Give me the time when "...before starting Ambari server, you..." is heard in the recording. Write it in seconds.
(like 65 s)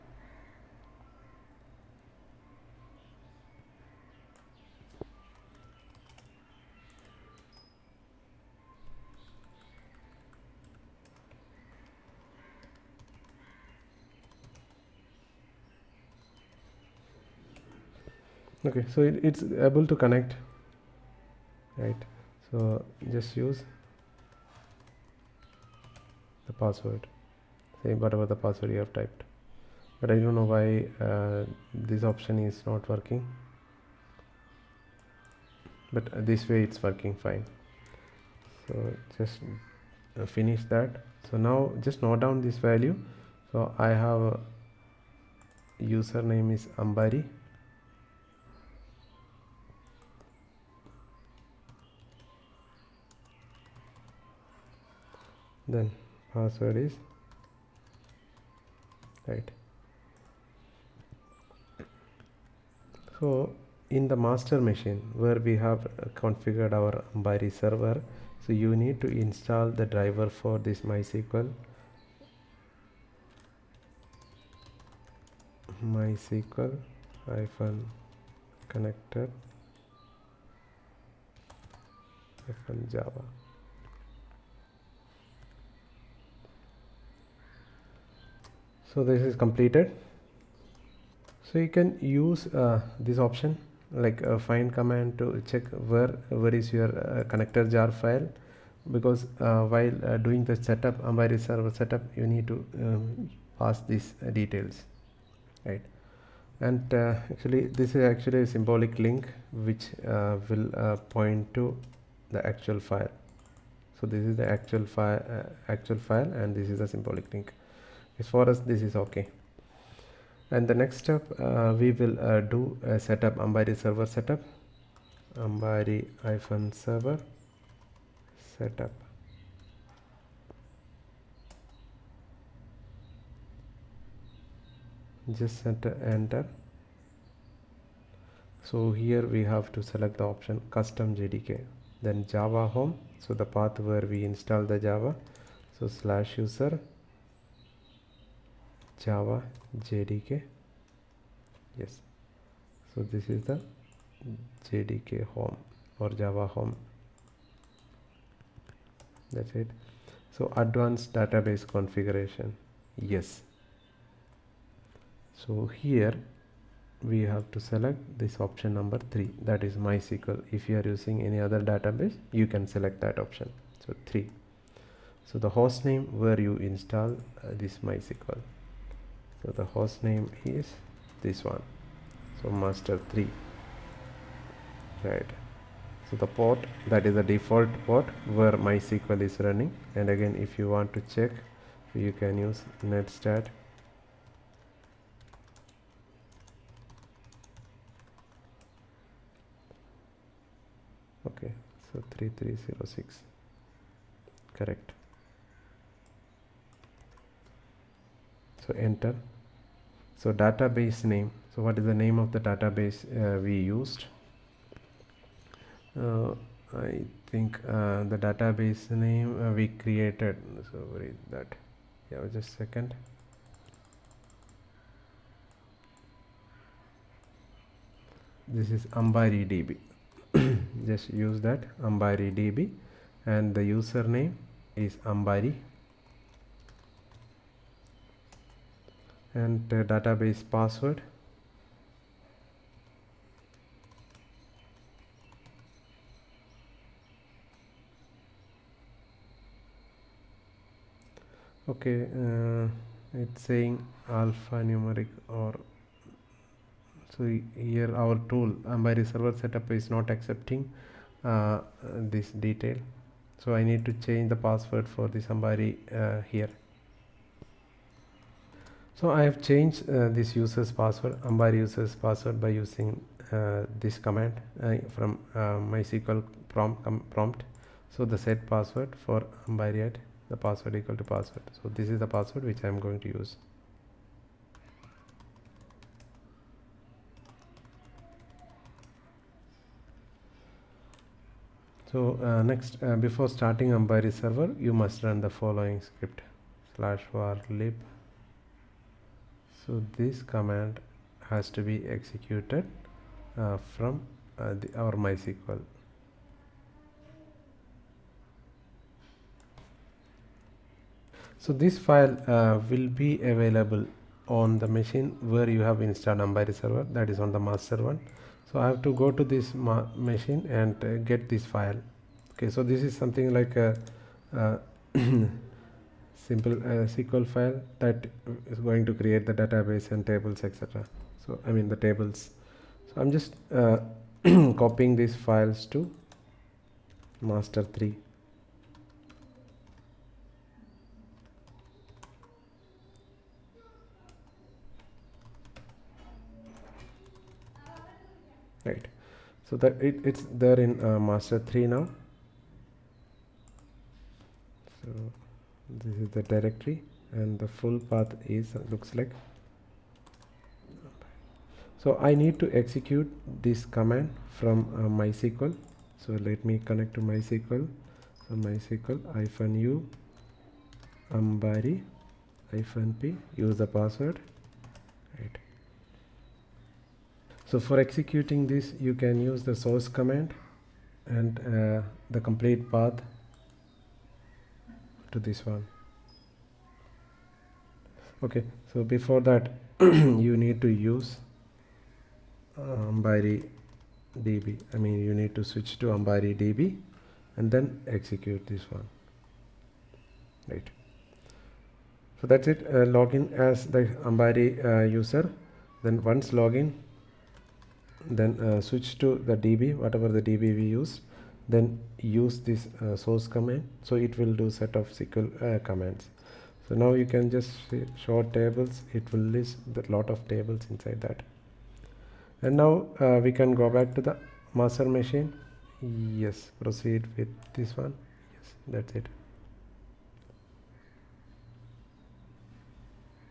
292 s.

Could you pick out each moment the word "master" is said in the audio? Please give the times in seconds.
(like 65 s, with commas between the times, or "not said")
64 s, 182 s, 317 s, 337 s, 350 s, 424 s.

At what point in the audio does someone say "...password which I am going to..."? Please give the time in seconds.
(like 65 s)
282 s.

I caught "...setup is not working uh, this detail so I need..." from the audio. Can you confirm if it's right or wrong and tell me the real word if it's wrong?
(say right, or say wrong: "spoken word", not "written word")
wrong: "accepting", not "working".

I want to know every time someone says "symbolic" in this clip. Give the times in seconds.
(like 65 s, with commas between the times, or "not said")
108 s, 116 s.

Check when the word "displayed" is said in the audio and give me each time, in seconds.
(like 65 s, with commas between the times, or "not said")
not said.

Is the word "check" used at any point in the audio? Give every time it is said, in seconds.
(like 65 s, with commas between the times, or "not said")
95 s, 191 s.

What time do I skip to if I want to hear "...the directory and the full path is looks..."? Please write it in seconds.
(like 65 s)
356 s.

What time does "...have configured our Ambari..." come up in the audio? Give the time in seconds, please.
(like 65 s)
65 s.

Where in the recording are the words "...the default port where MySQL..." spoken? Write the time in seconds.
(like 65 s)
187 s.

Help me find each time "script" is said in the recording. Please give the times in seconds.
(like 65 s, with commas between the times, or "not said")
295 s.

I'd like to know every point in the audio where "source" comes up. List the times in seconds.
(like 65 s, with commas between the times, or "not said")
379 s, 412 s.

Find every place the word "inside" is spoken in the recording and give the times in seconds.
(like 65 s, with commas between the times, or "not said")
420 s.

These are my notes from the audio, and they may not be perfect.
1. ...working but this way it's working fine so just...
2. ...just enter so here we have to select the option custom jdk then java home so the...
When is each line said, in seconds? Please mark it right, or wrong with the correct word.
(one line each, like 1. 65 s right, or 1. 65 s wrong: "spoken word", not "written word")
1. 32 s right
2. 135 s right.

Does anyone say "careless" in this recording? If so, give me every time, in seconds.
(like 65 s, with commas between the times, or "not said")
not said.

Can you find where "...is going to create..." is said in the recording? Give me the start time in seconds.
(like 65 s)
328 s.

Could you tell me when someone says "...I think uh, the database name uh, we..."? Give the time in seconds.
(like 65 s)
216 s.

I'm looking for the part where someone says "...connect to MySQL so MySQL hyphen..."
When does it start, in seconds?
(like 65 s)
366 s.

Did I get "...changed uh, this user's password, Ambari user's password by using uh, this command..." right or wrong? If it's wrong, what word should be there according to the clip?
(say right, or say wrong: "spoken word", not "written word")
right.